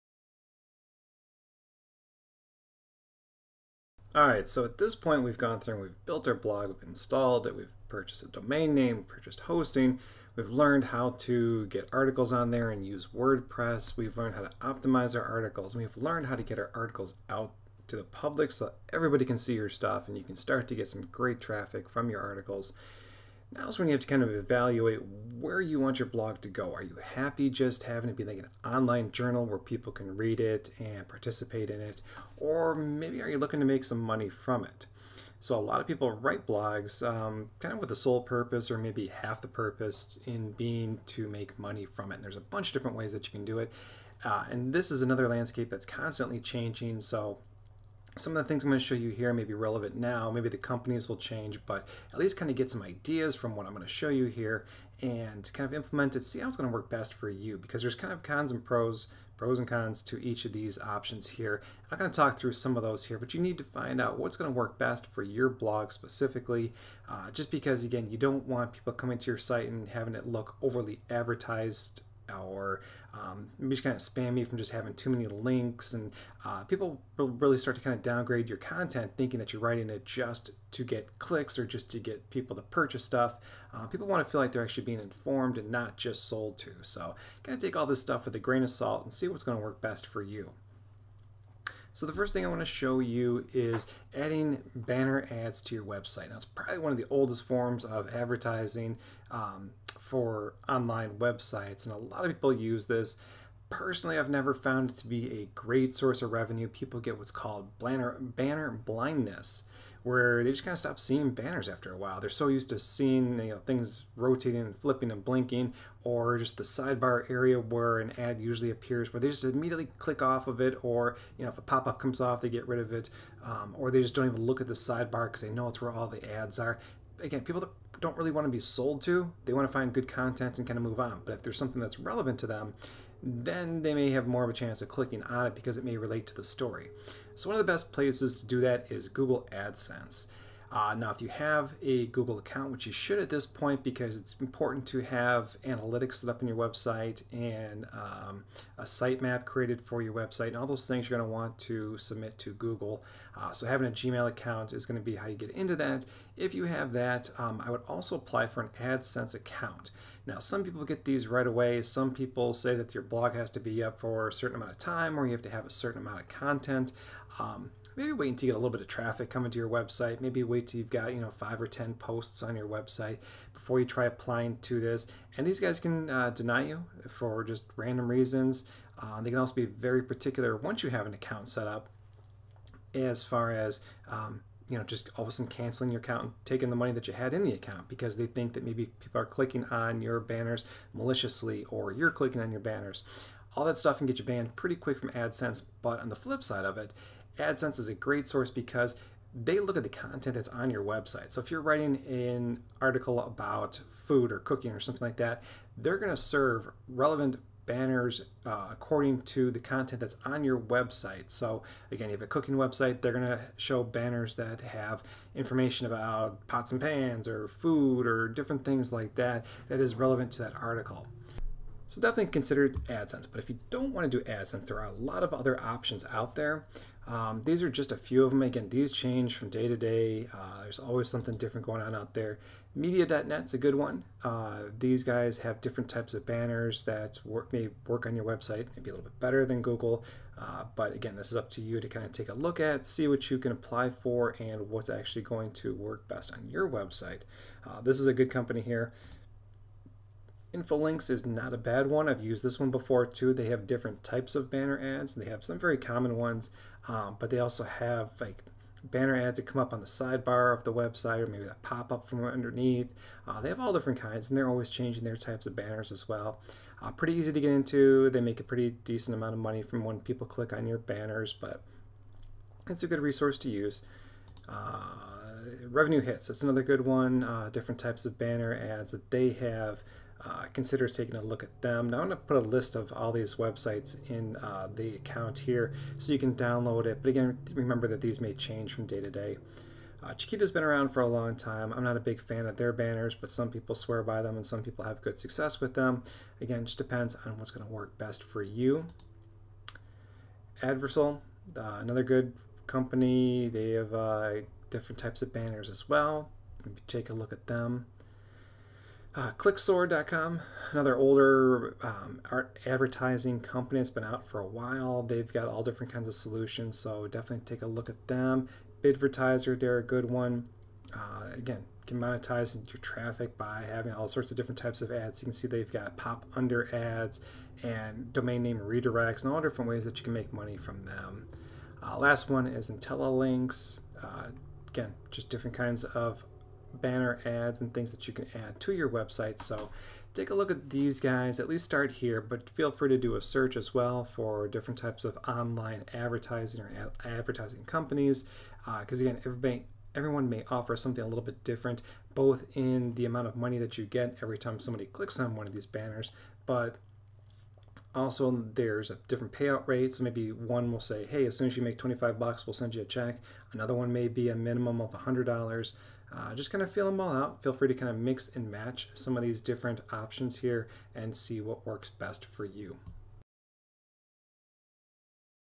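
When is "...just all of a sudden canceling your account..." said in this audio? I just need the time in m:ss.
3:04.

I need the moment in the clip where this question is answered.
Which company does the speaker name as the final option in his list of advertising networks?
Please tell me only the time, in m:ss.
5:32.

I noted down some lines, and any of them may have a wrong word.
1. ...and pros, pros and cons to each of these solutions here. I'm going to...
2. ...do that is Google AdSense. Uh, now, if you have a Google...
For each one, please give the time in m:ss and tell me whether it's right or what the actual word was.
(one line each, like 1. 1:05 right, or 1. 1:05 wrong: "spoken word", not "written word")
1. 0:58 wrong: "options", not "solutions"
2. 2:18 right.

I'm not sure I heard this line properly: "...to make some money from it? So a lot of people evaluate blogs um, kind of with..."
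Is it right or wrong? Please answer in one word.
wrong.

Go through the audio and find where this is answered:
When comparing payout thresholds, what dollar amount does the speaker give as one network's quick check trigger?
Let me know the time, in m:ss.
6:01.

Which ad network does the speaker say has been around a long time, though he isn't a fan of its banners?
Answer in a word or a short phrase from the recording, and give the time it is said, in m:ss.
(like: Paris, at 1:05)
Chitika, at 4:50.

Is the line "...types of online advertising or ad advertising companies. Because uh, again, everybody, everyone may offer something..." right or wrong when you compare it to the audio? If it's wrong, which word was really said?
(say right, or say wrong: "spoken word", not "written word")
right.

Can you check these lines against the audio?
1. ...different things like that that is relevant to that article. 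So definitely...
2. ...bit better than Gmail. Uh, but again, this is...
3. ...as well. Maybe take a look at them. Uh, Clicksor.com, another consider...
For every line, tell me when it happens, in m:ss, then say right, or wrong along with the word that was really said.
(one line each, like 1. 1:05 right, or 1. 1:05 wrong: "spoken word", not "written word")
1. 3:38 right
2. 3:59 wrong: "Google", not "Gmail"
3. 5:05 wrong: "older", not "consider".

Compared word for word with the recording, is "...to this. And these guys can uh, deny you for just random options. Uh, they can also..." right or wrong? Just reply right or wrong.
wrong.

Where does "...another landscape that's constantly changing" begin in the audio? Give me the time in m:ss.
0:45.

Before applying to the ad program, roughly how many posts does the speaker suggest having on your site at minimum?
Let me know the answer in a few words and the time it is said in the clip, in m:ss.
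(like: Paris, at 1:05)
5 or 10, at 2:51.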